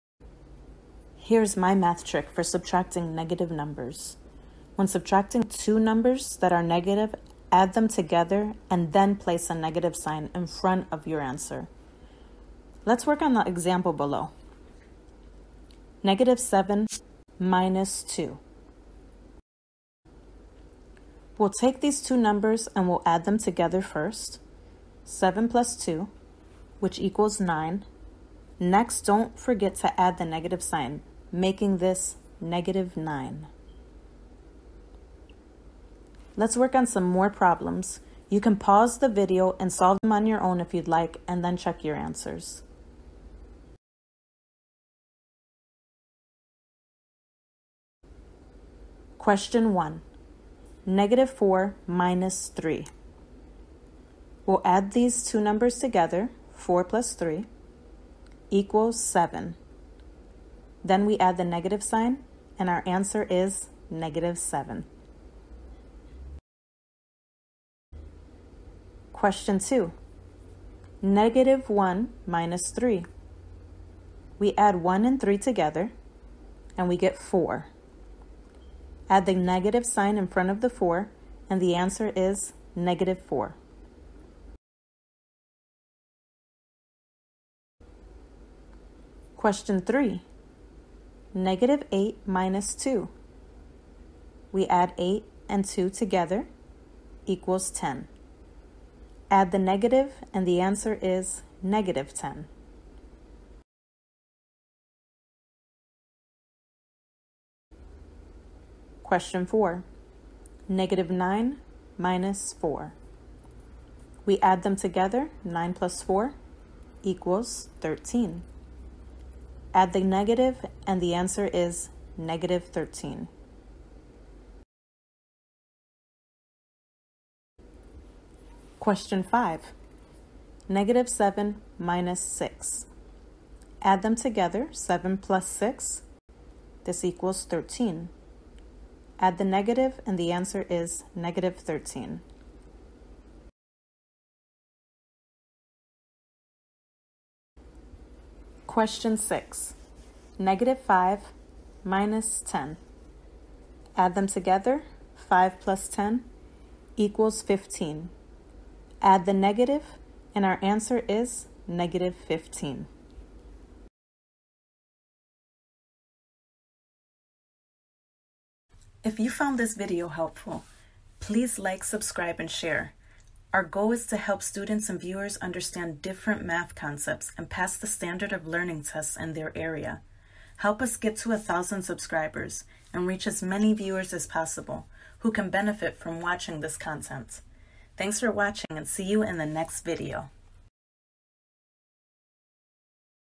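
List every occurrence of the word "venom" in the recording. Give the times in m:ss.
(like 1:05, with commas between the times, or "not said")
not said.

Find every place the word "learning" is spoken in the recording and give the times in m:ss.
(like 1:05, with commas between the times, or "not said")
2:58.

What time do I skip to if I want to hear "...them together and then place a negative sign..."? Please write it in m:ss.
0:07.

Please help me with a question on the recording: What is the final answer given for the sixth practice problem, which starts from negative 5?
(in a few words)
-15.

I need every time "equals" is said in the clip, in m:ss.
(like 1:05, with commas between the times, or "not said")
0:26, 0:58, 1:37, 1:57, 2:17, 2:36.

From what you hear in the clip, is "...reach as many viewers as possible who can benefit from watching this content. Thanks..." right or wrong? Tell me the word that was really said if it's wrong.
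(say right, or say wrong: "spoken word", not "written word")
right.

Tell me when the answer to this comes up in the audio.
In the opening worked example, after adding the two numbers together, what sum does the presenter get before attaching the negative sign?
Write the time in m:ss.
0:26.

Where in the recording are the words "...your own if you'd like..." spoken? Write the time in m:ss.
0:40.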